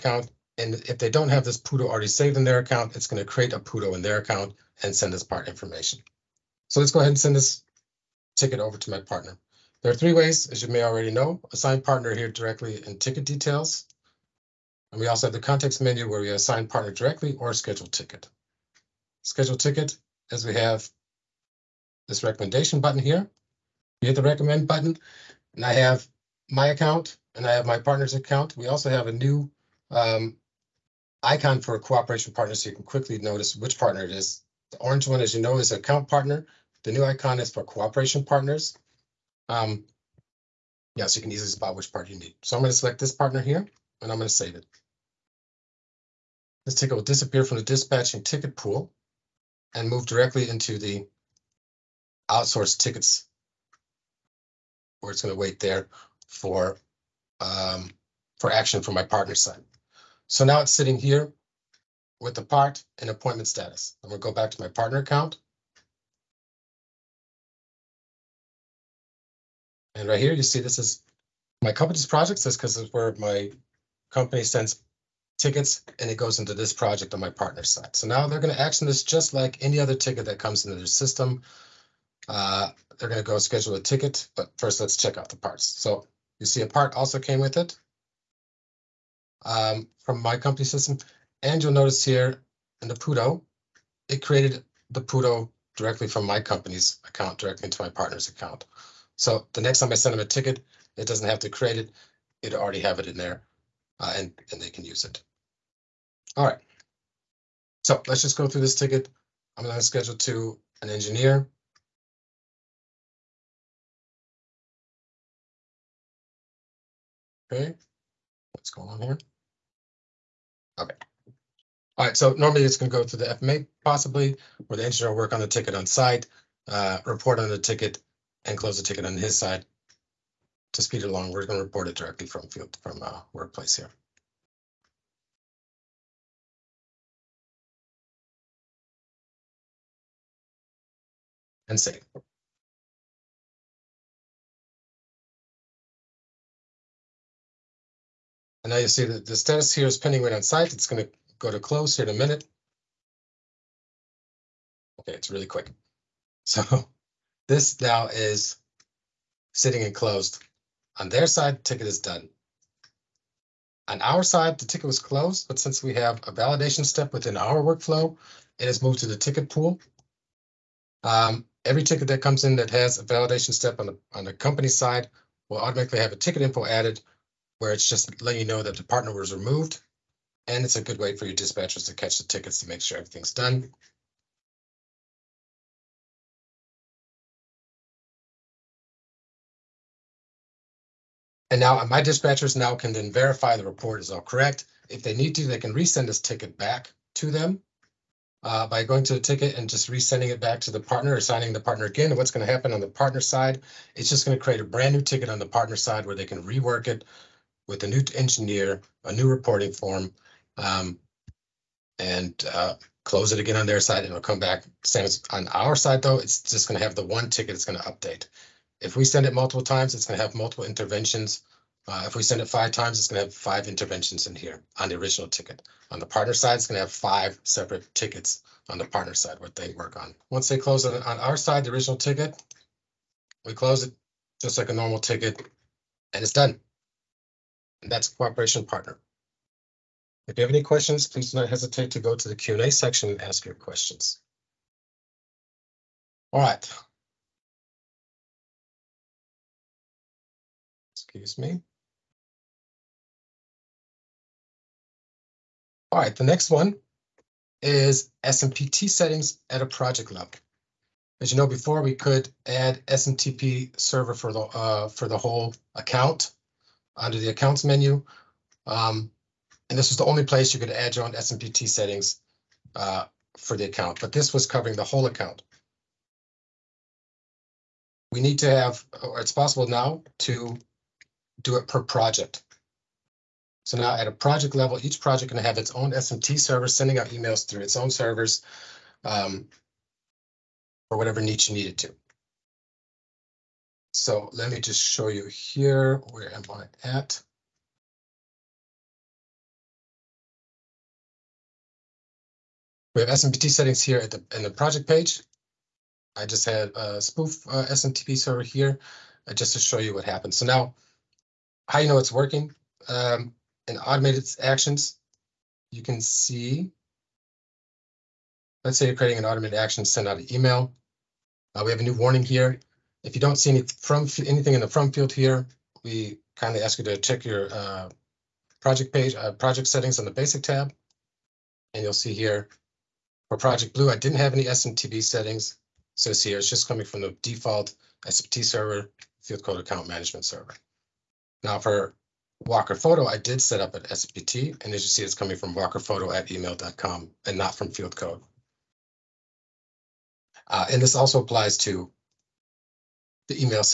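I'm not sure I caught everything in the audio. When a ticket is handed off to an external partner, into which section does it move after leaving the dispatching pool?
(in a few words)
Outsourced tickets.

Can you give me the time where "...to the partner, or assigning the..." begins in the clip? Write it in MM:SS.
03:20.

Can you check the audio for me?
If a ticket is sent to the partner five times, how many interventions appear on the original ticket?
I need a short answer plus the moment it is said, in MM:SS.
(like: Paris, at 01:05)
5, at 03:43.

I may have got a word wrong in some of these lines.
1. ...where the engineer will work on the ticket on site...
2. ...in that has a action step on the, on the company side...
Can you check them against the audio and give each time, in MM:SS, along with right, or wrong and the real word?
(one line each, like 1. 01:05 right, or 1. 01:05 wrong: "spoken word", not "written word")
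1. 02:04 right
2. 02:52 wrong: "validation", not "action".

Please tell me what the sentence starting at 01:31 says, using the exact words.
And you'll notice here in the Pudo, it created the Pudo directly from my company's account directly into my partner's account.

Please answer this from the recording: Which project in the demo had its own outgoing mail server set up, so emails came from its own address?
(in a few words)
Walker Photo.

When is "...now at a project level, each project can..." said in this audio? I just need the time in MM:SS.
04:43.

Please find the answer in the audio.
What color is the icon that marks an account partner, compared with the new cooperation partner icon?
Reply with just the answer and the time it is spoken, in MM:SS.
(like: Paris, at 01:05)
Orange, at 00:34.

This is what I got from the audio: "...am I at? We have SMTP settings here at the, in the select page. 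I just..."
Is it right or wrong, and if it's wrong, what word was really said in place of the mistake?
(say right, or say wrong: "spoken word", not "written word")
wrong: "project", not "select".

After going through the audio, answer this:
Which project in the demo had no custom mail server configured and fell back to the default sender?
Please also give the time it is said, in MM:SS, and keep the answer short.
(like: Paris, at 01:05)
Project Blue, at 05:33.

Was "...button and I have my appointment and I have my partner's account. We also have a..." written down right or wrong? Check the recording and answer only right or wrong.
wrong.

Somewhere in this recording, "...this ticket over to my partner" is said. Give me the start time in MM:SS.
00:07.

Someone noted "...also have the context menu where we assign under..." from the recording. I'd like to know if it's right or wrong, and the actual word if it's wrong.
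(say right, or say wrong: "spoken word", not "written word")
wrong: "partner", not "under".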